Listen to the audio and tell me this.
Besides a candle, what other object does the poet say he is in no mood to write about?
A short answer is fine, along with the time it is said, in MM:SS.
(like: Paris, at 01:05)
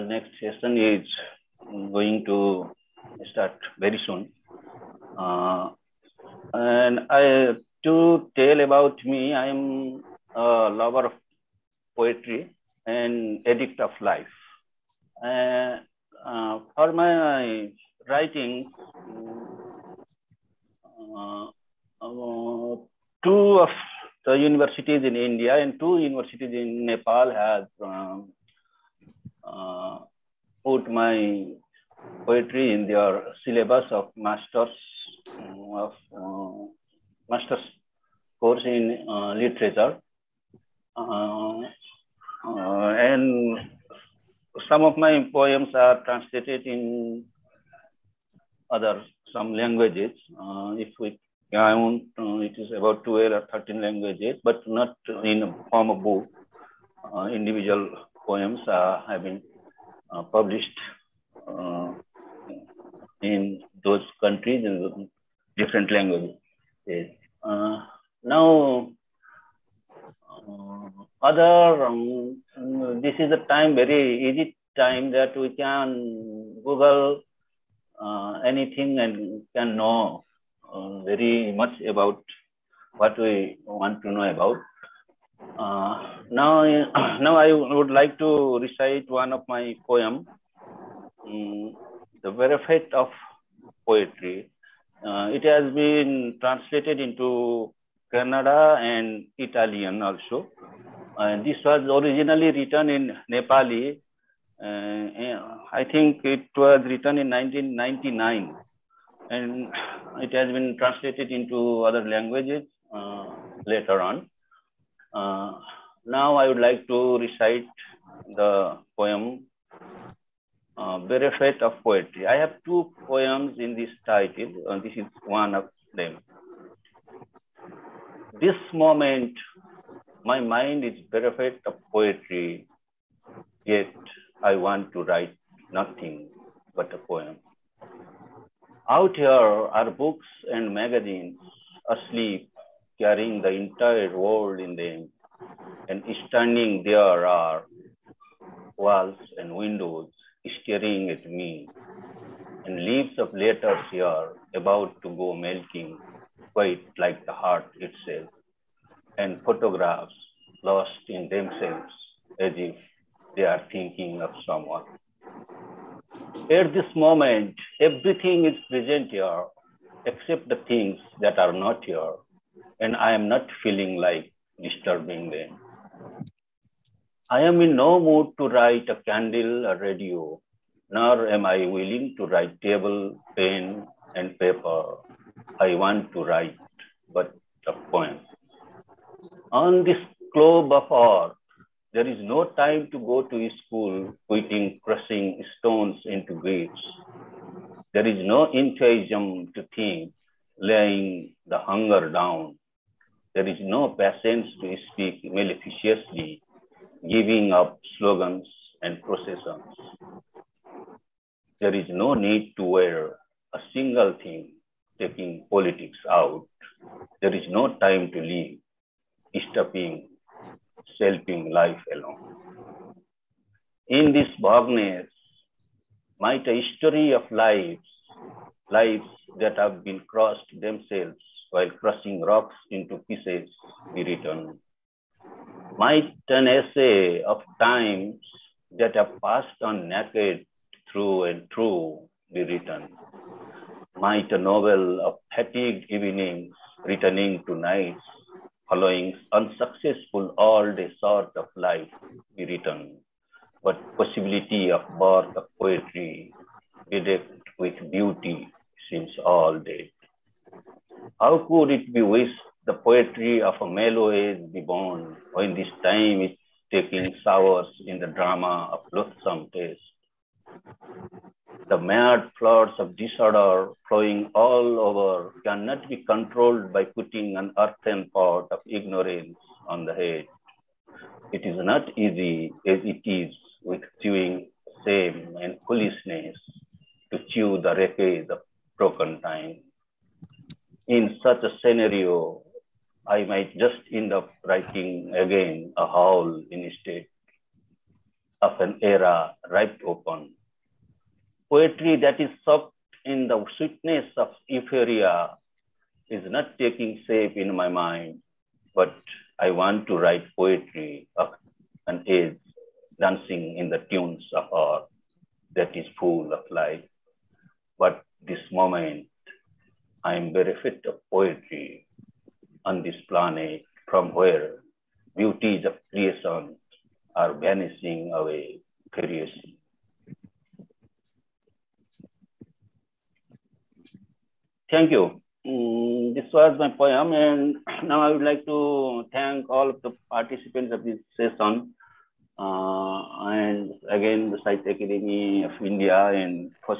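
Radio, at 02:59.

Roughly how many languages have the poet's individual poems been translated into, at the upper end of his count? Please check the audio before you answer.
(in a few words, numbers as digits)
13.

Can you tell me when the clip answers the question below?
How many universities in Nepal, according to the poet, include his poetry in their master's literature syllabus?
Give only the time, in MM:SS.
00:25.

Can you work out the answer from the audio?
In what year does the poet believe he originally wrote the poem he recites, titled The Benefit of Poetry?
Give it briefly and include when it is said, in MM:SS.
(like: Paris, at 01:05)
1999, at 01:47.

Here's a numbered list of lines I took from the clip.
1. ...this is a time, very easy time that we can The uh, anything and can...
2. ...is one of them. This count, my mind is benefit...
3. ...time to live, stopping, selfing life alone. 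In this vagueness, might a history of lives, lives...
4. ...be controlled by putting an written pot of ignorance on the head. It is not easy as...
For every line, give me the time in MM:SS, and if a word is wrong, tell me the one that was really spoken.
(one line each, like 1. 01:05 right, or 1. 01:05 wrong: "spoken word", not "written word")
1. 01:13 wrong: "Google", not "The"
2. 02:04 wrong: "moment", not "count"
3. 03:37 right
4. 04:35 wrong: "earthen", not "written".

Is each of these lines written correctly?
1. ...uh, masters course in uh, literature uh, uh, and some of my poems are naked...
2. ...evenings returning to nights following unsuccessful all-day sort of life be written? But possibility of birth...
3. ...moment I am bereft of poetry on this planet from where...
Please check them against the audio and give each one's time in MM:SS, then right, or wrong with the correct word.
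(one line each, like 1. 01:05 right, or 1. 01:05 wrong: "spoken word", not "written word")
1. 00:36 wrong: "translated", not "naked"
2. 04:05 right
3. 05:18 right.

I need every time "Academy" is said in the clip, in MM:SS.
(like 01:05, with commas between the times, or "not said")
05:44.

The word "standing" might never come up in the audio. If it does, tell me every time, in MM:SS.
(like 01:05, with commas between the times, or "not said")
02:26.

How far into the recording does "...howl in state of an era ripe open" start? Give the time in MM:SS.
04:55.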